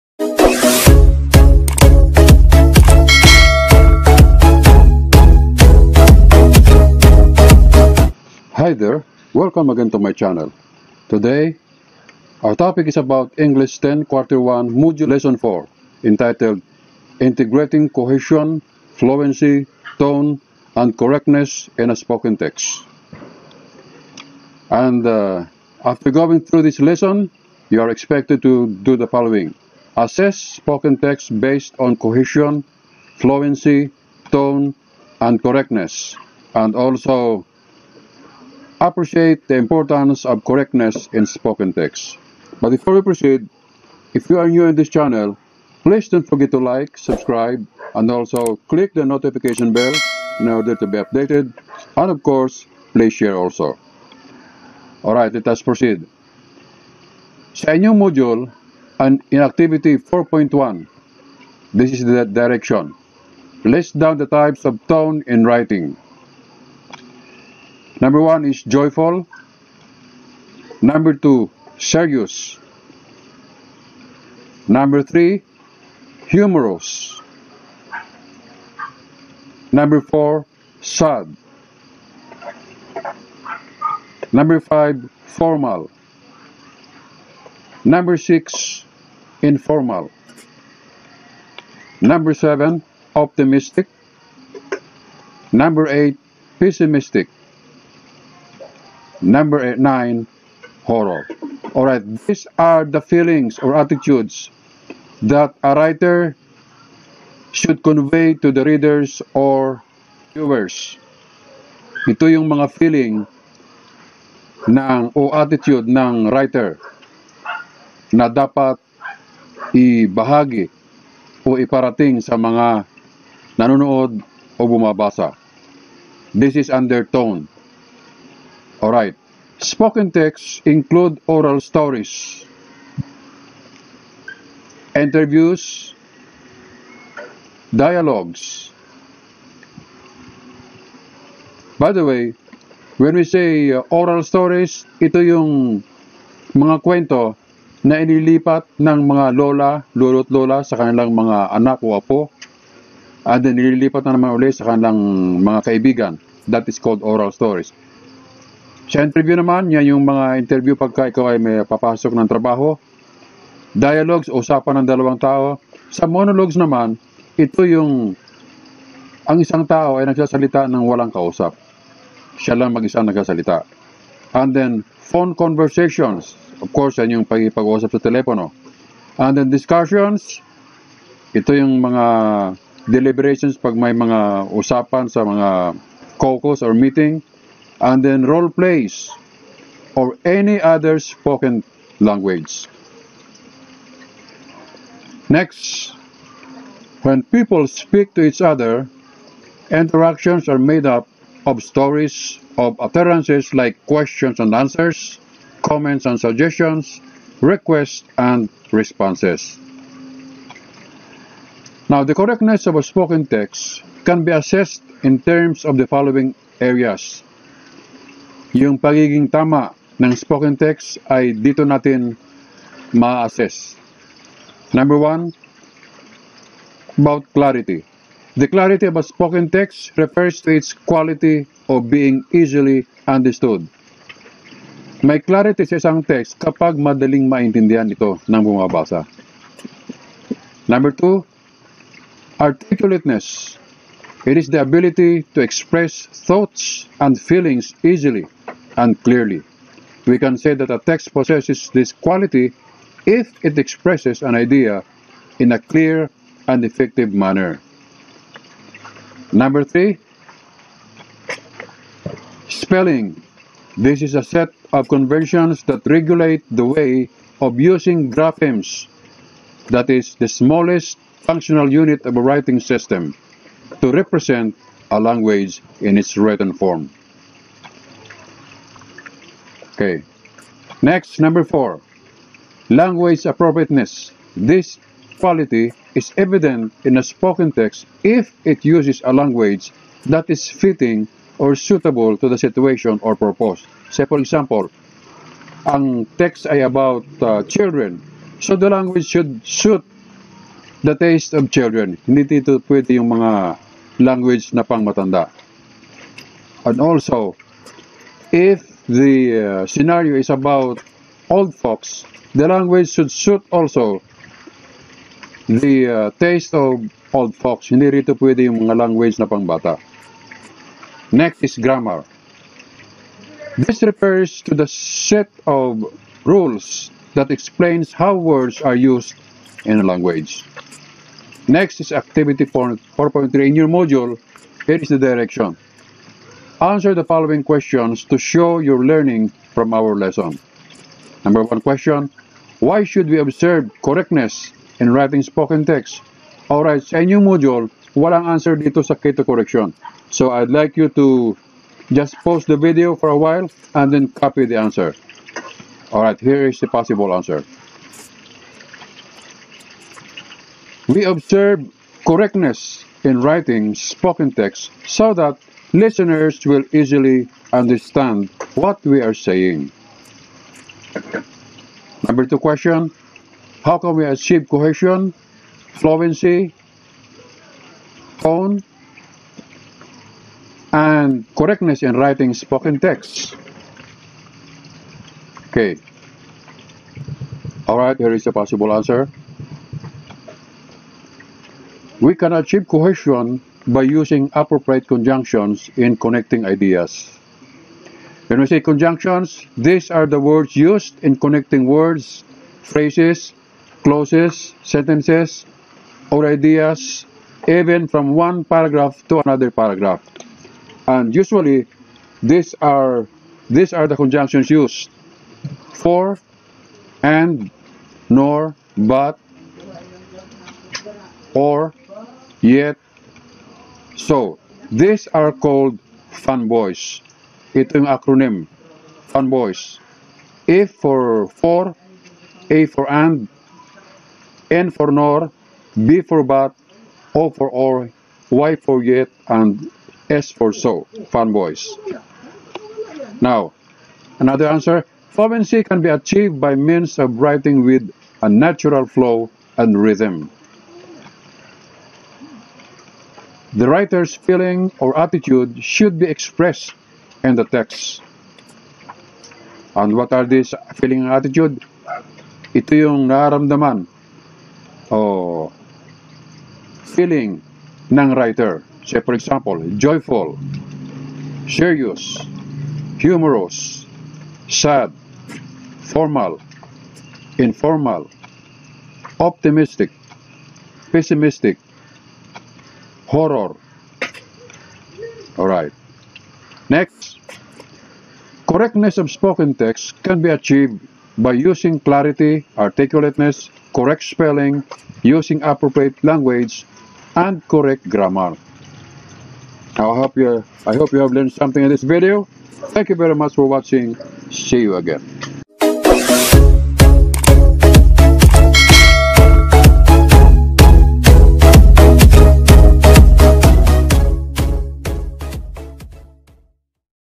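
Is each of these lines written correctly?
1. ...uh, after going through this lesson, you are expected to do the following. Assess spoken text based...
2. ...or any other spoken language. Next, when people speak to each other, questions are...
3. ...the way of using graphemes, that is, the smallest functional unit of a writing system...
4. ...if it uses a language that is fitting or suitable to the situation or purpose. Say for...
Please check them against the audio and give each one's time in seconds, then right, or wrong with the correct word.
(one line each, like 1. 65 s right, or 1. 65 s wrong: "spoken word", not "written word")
1. 25 s right
2. 189 s wrong: "interactions", not "questions"
3. 266 s right
4. 288 s right.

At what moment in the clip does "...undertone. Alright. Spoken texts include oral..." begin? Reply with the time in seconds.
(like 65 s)
126 s.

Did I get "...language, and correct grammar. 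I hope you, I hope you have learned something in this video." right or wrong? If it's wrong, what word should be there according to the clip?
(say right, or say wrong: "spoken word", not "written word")
right.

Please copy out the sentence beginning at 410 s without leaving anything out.
And usually, these are these are the conjunctions used: for, and, nor, but, or, yet, so, these are called fanboys.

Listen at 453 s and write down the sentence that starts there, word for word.
The writer's feeling or attitude should be expressed in the text.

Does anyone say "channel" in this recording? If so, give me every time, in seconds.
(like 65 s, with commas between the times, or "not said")
10 s, 44 s.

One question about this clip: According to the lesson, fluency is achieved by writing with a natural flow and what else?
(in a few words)
Rhythm.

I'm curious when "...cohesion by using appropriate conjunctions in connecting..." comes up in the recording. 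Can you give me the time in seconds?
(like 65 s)
392 s.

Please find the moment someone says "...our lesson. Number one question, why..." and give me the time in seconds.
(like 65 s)
339 s.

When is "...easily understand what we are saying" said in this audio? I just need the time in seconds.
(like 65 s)
366 s.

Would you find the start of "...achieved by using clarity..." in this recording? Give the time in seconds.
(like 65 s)
490 s.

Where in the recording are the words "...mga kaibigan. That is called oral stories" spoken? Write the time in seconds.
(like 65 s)
155 s.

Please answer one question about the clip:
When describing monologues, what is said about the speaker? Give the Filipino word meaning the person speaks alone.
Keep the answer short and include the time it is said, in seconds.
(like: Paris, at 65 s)
mag-isa, at 172 s.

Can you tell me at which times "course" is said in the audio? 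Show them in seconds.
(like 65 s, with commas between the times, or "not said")
52 s, 176 s.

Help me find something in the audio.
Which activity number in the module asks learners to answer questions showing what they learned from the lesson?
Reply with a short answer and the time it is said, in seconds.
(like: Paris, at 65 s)
4.3, at 331 s.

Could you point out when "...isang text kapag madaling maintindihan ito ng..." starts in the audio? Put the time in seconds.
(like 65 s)
235 s.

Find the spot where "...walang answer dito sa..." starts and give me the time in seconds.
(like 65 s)
347 s.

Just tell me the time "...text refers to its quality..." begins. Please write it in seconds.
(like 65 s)
229 s.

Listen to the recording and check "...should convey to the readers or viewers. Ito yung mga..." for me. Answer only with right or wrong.
right.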